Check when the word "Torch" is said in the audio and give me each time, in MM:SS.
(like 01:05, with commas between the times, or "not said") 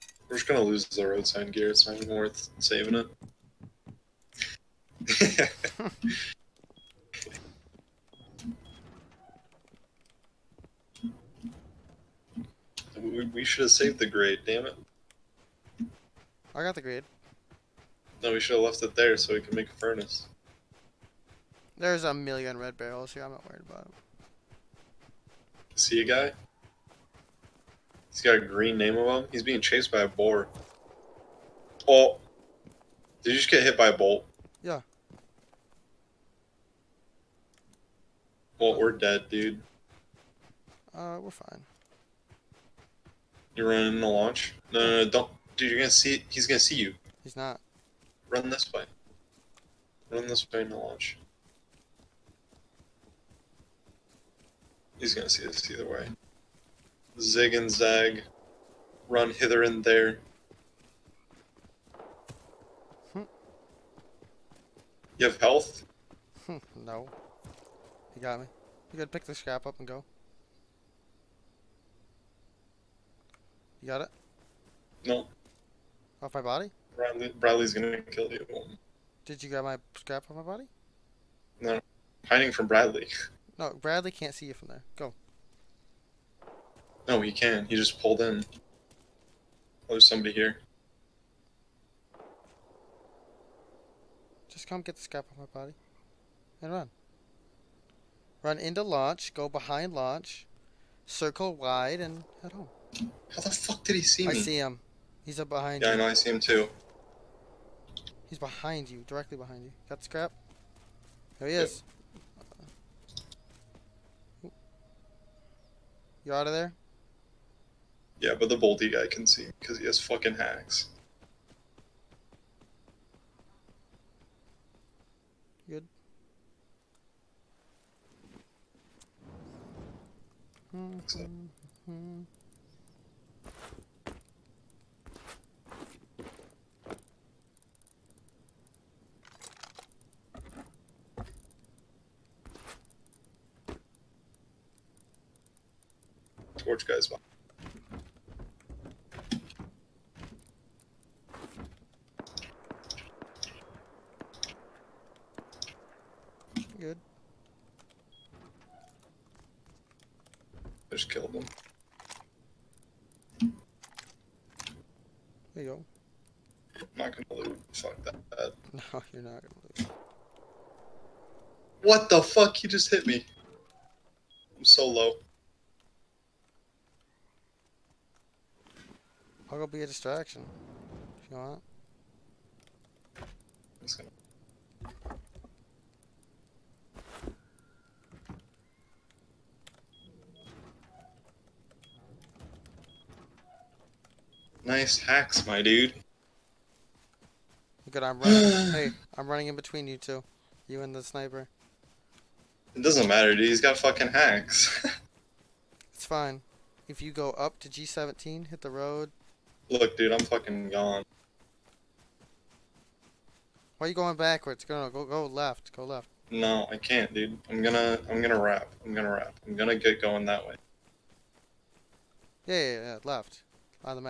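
02:26.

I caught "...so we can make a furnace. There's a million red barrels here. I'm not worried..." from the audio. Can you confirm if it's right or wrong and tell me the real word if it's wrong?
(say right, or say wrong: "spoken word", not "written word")
right.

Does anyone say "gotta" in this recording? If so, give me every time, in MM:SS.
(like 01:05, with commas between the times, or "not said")
01:08.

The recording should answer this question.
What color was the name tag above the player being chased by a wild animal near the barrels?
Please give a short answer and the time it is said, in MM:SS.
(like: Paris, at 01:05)
green, at 00:28.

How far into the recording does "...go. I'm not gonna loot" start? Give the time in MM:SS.
02:45.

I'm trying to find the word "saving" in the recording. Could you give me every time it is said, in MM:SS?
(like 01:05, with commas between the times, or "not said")
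00:02.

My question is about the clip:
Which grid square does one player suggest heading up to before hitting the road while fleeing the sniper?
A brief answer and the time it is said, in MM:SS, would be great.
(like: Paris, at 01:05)
G17, at 03:27.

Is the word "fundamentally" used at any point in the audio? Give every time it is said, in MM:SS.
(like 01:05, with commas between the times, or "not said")
not said.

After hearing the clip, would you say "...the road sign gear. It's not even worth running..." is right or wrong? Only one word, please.
wrong.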